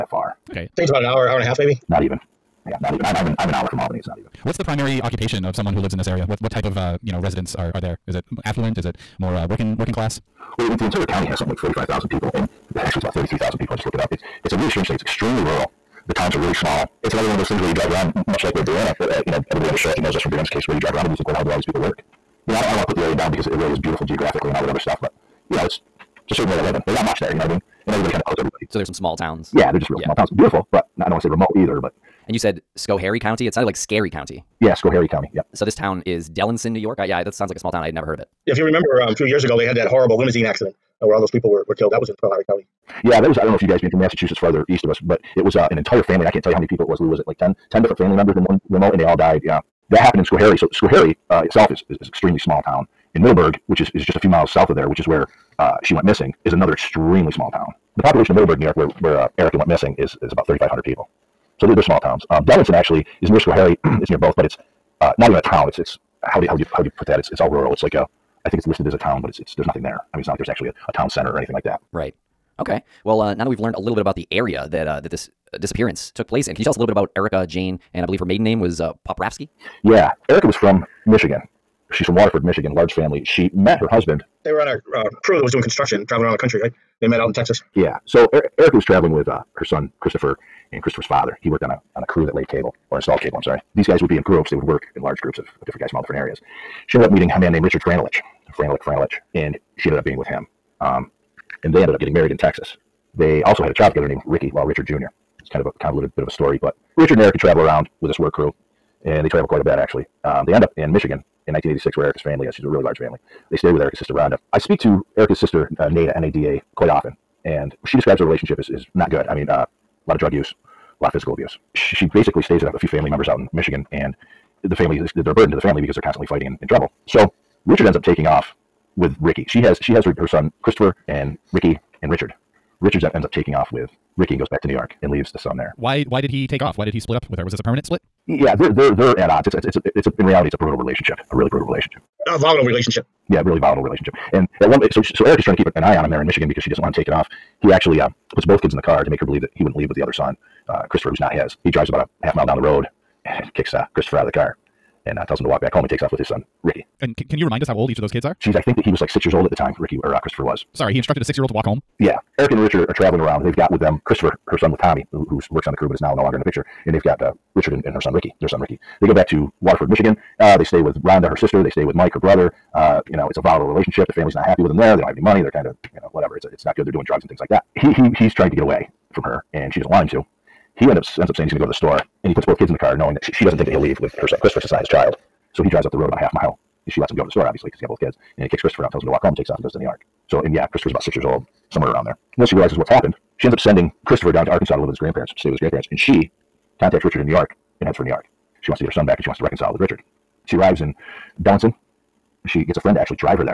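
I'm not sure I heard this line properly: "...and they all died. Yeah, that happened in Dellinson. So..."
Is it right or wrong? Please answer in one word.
wrong.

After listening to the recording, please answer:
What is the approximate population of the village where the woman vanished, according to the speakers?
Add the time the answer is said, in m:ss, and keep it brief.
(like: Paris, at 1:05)
3,500, at 1:00.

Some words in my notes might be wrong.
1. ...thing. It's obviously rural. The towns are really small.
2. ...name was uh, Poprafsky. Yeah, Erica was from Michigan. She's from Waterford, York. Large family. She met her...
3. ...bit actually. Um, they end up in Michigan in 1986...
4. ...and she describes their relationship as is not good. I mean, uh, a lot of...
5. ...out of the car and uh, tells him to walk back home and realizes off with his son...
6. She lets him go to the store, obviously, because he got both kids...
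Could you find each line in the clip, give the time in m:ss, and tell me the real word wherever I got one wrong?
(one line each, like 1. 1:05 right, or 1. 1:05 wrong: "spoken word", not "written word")
1. 0:14 wrong: "extremely", not "obviously"
2. 1:18 wrong: "Michigan", not "York"
3. 1:49 right
4. 1:57 right
5. 2:34 wrong: "takes", not "realizes"
6. 3:06 right.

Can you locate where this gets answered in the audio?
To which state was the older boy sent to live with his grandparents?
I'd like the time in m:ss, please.
3:14.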